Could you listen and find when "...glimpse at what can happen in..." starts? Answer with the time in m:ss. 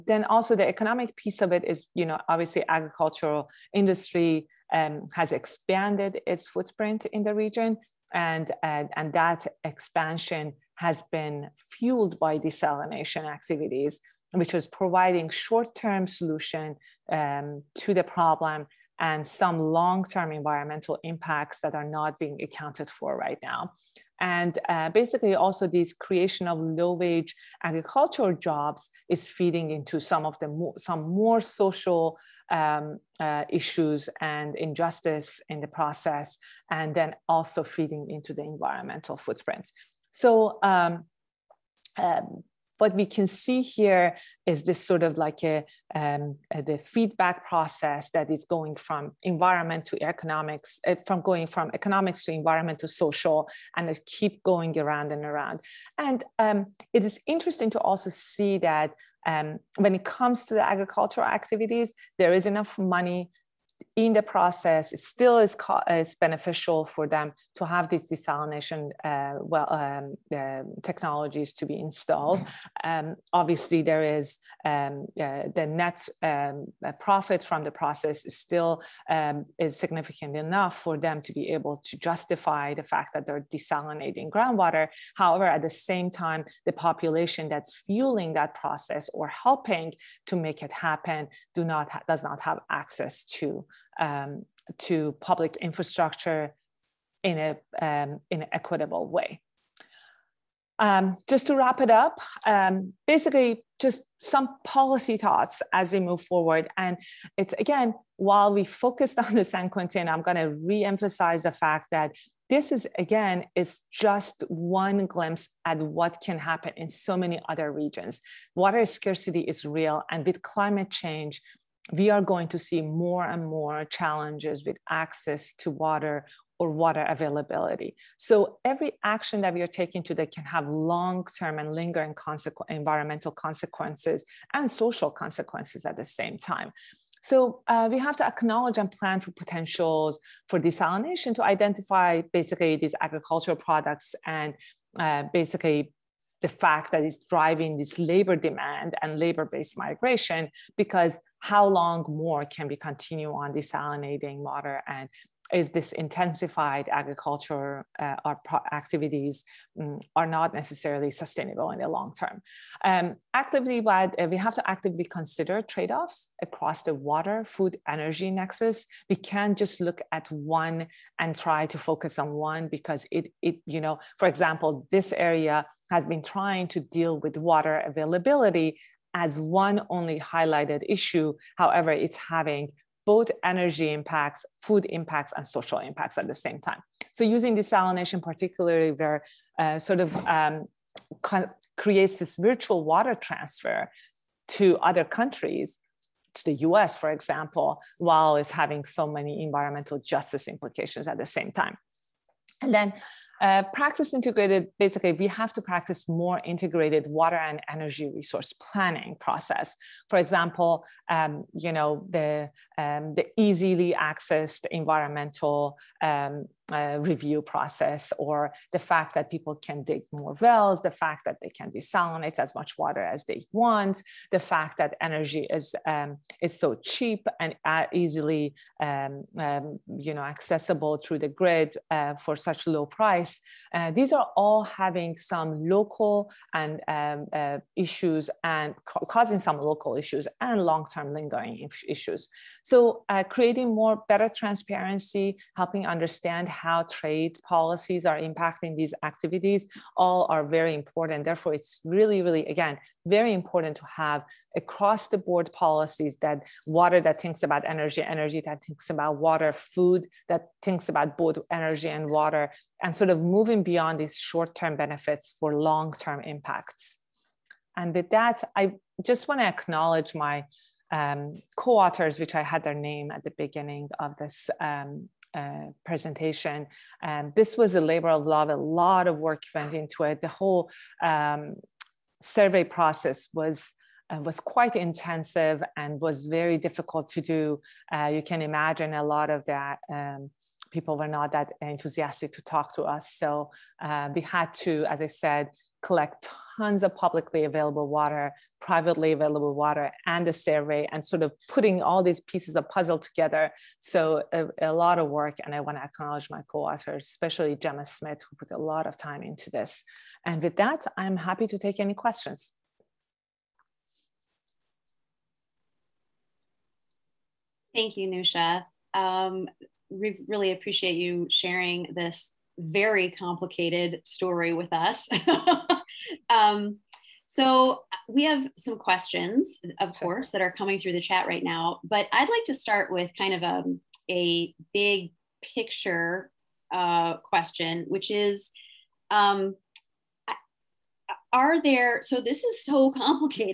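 1:55.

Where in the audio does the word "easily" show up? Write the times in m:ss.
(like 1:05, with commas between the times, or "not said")
3:33, 3:47.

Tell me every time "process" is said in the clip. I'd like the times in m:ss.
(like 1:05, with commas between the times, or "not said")
0:35, 0:47, 1:04, 1:17, 1:28, 3:29, 3:37, 4:42.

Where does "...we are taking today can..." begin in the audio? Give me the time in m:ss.
2:09.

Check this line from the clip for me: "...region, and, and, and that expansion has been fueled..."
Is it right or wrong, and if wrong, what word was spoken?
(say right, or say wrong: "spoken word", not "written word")
right.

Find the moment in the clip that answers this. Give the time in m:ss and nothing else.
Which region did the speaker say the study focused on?
1:49.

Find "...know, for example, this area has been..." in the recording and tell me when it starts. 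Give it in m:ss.
2:53.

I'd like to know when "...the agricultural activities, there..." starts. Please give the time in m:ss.
1:00.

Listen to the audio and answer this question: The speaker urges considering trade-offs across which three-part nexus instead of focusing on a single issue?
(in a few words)
water, food, energy.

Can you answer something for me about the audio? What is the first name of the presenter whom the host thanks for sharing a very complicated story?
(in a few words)
Newsha.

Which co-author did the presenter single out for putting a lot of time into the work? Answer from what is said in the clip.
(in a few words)
Gemma Smith.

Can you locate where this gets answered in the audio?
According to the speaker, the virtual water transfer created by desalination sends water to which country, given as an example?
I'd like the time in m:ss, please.
3:16.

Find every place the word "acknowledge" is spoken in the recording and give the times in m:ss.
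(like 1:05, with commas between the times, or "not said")
2:18, 4:29, 5:05.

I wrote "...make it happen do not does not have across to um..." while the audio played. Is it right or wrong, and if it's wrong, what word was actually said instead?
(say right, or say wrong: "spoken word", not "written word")
wrong: "access", not "across".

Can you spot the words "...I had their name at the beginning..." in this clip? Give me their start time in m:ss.
4:32.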